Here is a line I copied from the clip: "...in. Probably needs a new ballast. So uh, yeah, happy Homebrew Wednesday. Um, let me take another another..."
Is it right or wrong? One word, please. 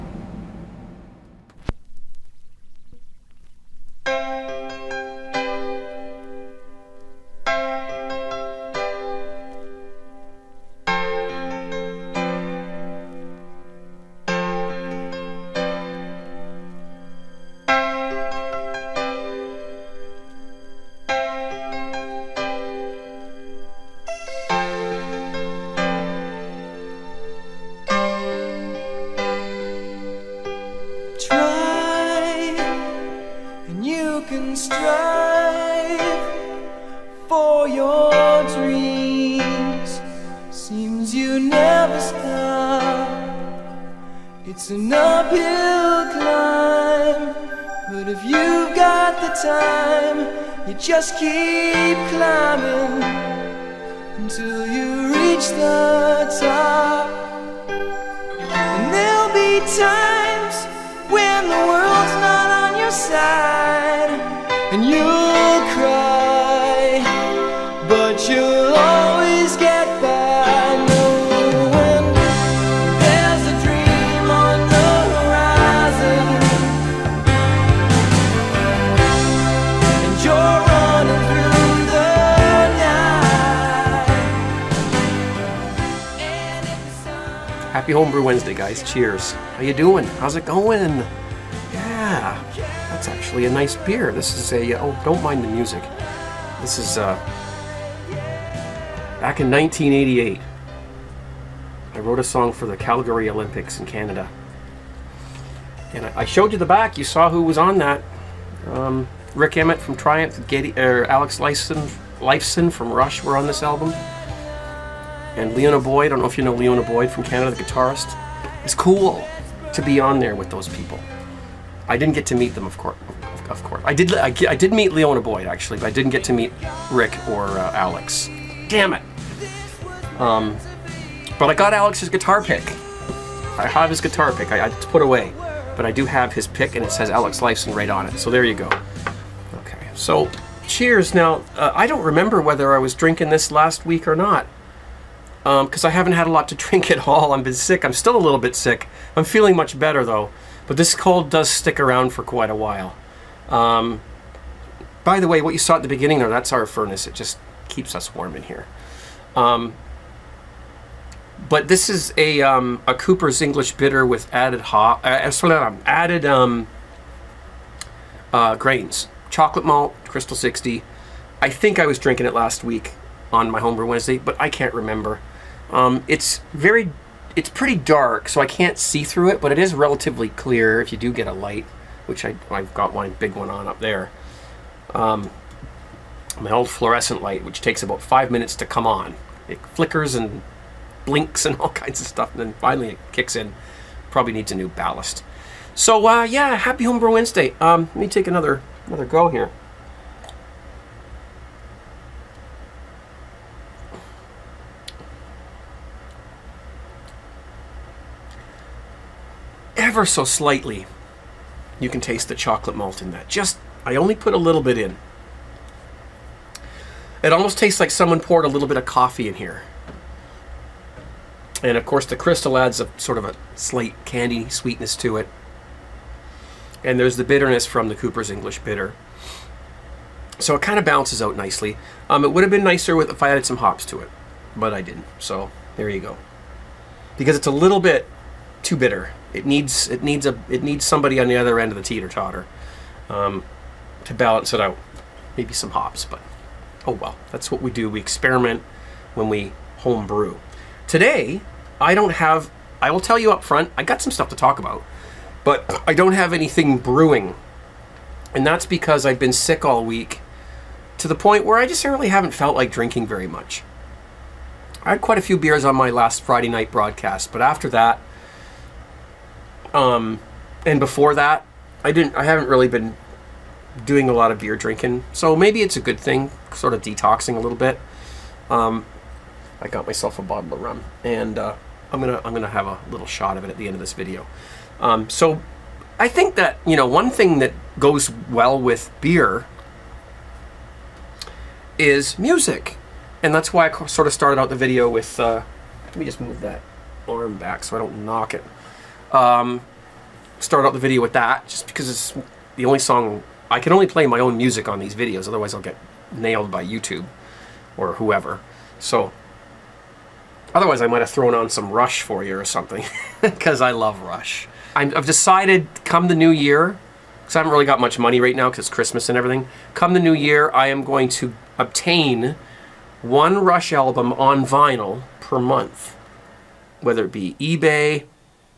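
right.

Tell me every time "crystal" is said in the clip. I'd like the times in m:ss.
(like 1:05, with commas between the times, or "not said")
2:50, 3:42.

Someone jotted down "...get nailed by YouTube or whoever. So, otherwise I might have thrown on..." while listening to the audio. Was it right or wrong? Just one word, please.
right.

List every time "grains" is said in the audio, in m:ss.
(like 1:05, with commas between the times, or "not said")
2:48.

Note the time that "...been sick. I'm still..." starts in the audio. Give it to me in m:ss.
2:27.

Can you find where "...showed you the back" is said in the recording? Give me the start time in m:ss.
1:46.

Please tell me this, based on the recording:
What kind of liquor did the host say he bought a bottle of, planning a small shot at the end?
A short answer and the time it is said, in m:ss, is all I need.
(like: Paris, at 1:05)
Rum, at 4:40.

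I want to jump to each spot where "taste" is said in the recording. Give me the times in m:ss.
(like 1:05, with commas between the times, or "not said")
3:31, 3:37.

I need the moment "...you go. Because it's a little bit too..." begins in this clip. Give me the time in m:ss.
3:55.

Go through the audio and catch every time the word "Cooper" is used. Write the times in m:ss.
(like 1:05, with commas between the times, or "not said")
2:42, 3:47.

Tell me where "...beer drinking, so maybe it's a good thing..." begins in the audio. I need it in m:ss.
4:34.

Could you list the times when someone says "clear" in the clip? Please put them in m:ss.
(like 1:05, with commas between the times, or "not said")
3:00.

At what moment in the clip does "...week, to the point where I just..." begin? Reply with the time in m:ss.
4:19.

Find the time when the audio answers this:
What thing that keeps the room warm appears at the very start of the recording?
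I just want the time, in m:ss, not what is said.
2:36.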